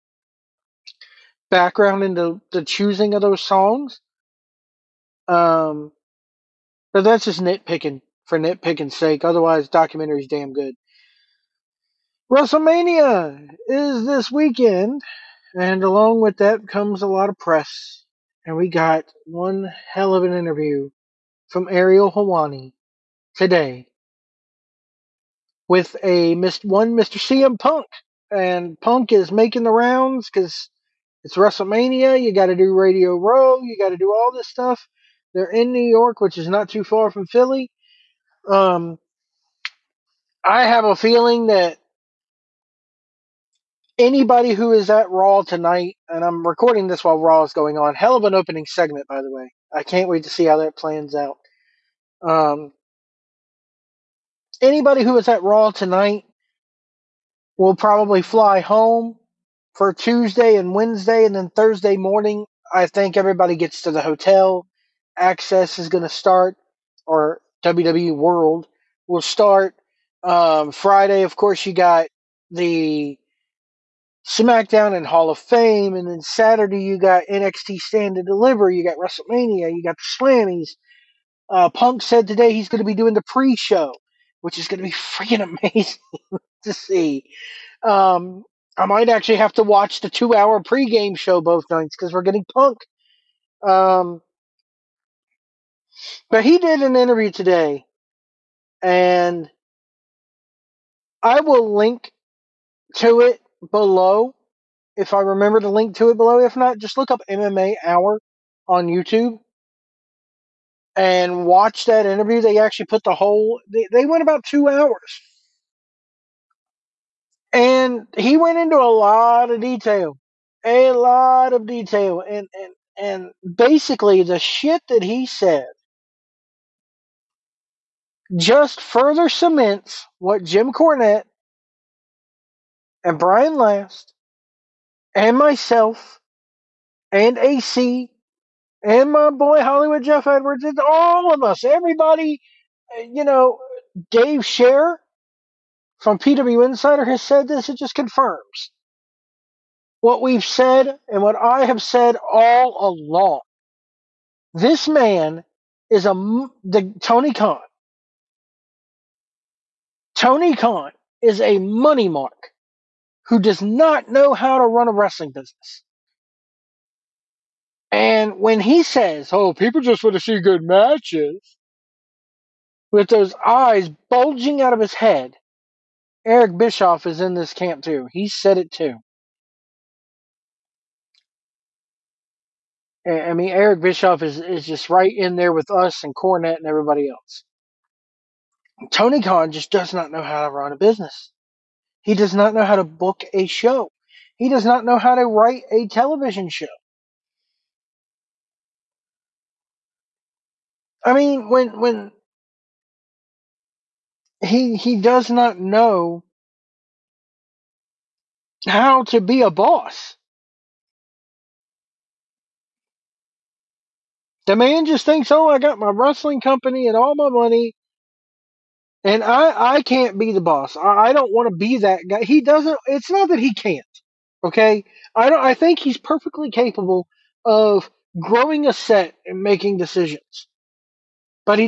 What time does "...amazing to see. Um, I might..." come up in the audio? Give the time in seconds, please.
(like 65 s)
85 s.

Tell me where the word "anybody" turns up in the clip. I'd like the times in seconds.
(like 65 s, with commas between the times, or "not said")
43 s, 54 s.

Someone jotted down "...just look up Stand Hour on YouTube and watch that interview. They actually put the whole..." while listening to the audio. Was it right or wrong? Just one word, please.
wrong.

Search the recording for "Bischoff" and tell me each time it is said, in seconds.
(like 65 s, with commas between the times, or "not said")
176 s, 183 s.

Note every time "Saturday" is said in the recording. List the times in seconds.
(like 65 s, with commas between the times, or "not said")
76 s.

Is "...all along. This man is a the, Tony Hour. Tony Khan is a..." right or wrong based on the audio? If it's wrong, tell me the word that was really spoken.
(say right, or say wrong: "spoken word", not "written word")
wrong: "Khan", not "Hour".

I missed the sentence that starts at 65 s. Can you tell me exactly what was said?
Access is going to start, or WWE World will start.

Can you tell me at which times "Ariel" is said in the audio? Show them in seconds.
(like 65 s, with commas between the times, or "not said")
21 s.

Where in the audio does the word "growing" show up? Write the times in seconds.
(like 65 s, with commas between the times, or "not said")
228 s.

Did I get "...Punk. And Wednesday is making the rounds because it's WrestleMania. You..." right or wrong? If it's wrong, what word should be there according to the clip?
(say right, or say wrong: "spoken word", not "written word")
wrong: "Punk", not "Wednesday".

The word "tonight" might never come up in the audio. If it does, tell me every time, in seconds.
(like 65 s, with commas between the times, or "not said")
45 s, 55 s.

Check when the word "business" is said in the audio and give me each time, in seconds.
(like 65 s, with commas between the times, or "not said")
165 s, 190 s.